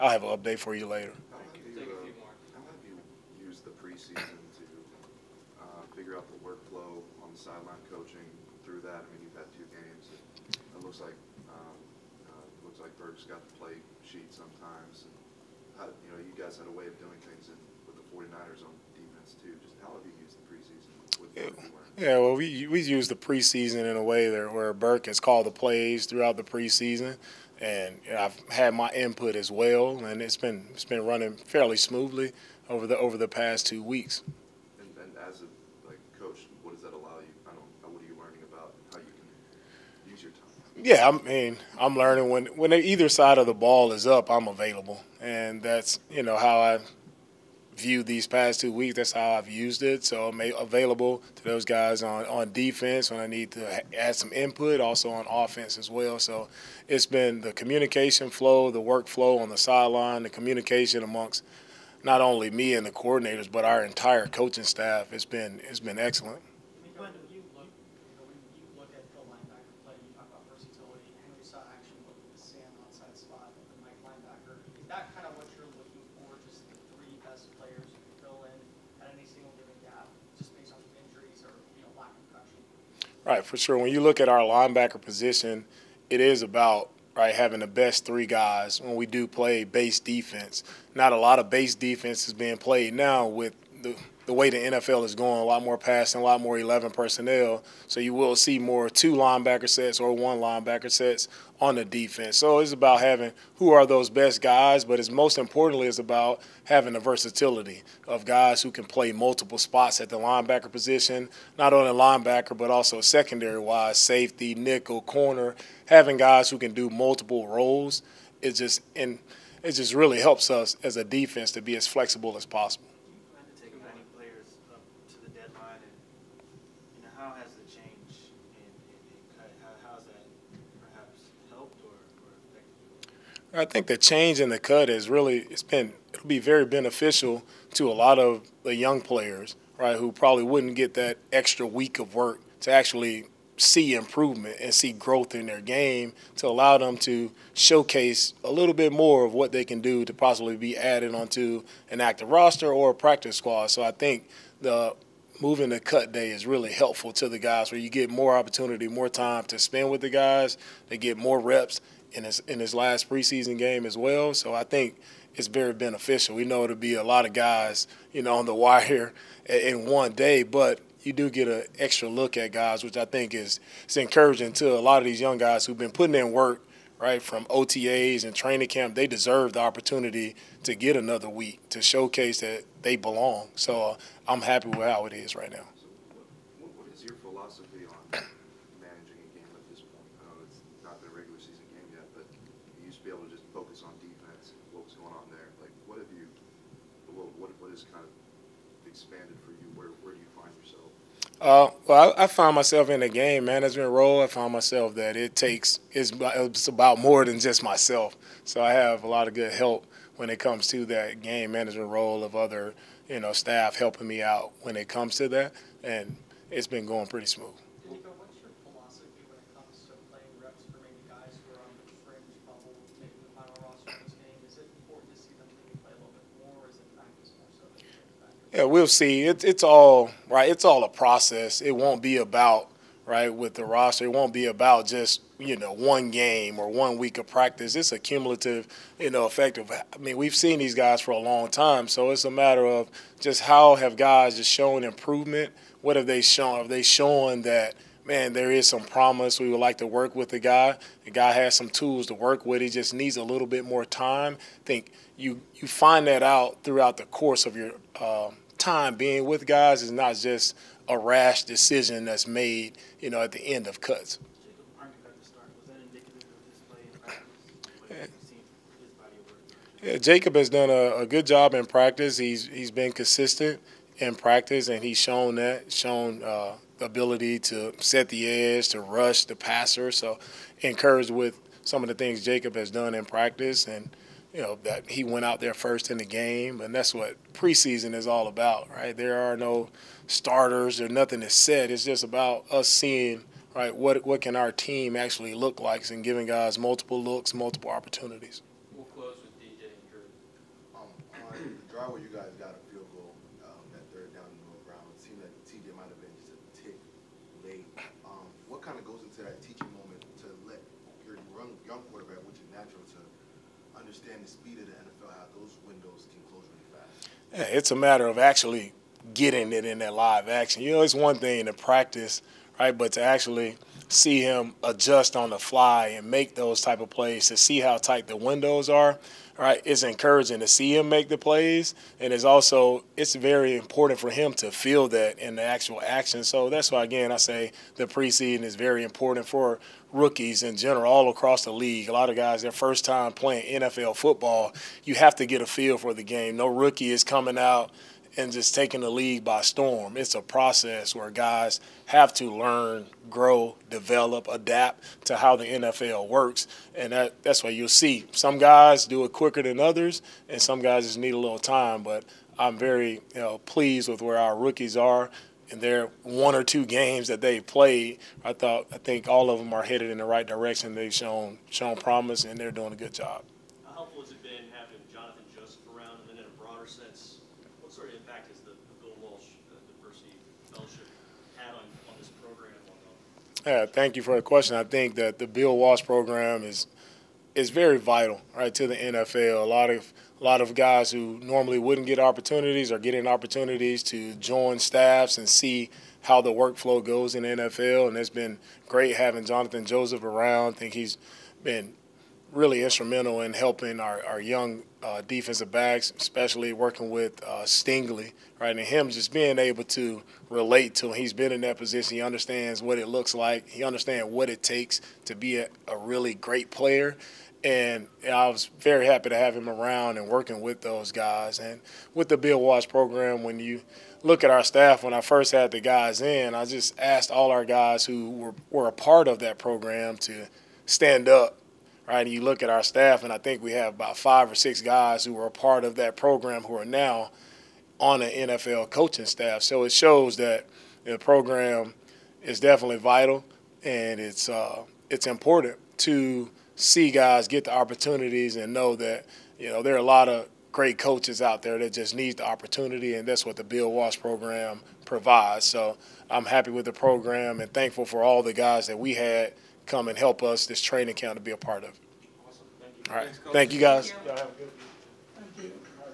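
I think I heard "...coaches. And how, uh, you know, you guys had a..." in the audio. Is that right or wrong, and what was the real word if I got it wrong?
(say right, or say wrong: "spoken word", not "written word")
wrong: "sometimes", not "coaches".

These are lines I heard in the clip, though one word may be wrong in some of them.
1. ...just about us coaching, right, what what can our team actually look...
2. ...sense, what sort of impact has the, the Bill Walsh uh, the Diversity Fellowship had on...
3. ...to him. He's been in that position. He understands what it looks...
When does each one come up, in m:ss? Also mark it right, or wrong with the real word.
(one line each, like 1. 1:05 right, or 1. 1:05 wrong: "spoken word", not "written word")
1. 4:51 wrong: "seeing", not "coaching"
2. 6:16 right
3. 6:50 right.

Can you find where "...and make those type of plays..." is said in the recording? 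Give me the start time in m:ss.
5:25.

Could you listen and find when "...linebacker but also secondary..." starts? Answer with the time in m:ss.
1:51.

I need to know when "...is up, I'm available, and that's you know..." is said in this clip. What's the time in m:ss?
0:43.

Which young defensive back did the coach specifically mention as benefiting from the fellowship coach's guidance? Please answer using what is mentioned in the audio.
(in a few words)
Stingley.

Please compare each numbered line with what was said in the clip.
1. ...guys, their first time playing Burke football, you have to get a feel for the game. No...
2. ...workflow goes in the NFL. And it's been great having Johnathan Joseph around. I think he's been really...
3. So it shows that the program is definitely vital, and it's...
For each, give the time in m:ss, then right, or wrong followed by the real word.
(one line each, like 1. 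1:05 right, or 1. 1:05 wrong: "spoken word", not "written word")
1. 5:42 wrong: "NFL", not "Burke"
2. 6:36 right
3. 7:19 right.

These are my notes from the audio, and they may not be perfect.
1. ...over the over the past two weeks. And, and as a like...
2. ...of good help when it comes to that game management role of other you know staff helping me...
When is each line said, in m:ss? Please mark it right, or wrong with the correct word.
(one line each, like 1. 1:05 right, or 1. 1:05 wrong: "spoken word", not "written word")
1. 0:32 right
2. 3:29 right.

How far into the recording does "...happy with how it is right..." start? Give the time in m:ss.
3:04.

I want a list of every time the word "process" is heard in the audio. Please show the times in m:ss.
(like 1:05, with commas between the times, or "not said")
3:50, 5:50.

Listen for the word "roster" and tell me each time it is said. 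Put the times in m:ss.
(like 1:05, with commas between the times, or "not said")
2:32, 3:53.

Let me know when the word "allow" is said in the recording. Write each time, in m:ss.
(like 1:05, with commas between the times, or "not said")
0:36, 2:26.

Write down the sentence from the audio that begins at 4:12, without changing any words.
He just needs a little bit more time.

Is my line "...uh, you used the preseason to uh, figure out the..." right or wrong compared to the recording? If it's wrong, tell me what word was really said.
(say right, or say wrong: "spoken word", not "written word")
right.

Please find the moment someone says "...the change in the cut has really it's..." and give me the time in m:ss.
2:13.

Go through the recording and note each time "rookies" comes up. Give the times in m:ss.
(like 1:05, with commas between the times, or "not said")
5:39, 5:46, 6:04.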